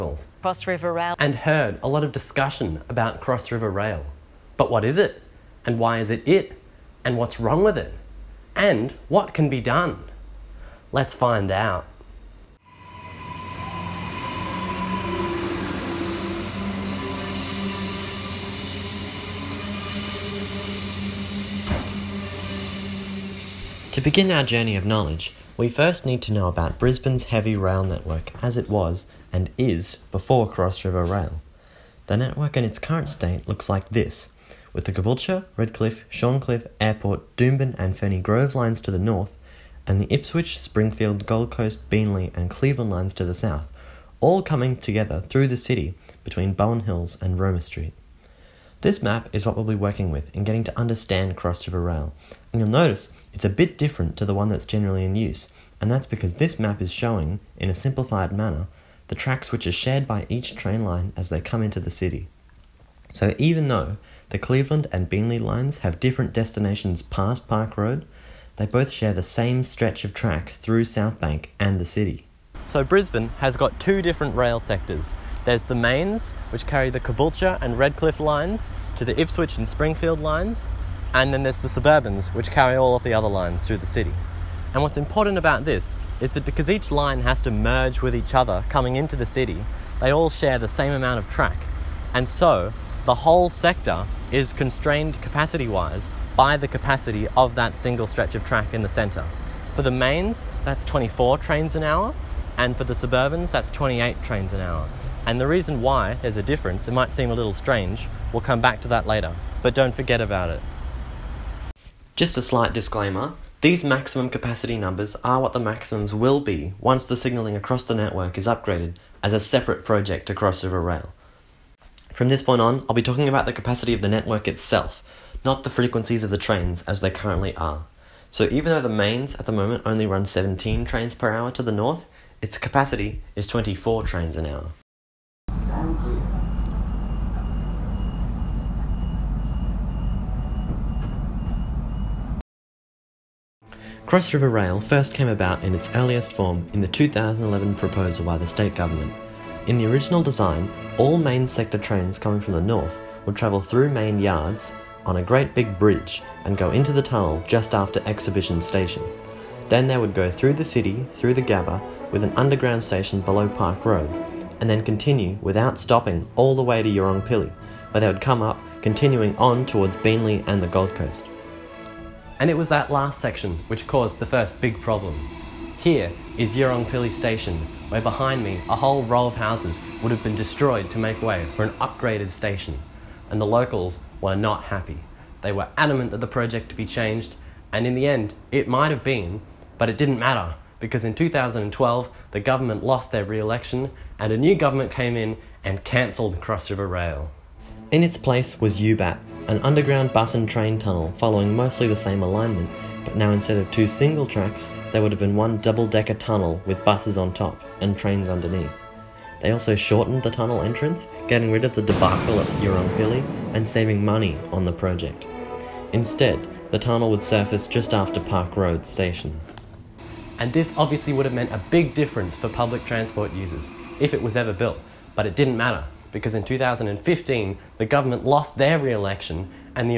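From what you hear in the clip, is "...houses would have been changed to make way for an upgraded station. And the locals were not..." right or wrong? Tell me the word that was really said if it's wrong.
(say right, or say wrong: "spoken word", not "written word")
wrong: "destroyed", not "changed".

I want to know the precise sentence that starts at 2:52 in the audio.
And it was that last section which caused the first big problem.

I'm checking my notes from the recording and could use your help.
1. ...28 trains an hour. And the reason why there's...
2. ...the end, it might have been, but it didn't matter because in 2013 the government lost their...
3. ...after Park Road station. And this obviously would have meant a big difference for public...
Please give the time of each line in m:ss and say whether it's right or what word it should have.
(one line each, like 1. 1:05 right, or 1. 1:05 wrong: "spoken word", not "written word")
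1. 1:43 right
2. 3:07 wrong: "2012", not "2013"
3. 3:37 right.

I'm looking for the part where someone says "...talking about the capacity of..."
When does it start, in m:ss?
2:03.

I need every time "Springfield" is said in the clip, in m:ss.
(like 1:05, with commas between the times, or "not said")
0:40, 1:19.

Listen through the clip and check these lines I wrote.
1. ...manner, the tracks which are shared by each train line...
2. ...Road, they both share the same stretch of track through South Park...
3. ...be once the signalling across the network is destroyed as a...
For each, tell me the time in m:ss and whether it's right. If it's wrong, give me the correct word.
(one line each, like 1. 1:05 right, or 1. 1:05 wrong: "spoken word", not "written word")
1. 0:58 right
2. 1:07 wrong: "Bank", not "Park"
3. 1:56 wrong: "upgraded", not "destroyed".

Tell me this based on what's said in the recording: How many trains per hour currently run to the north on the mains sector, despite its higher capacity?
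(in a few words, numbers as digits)
17.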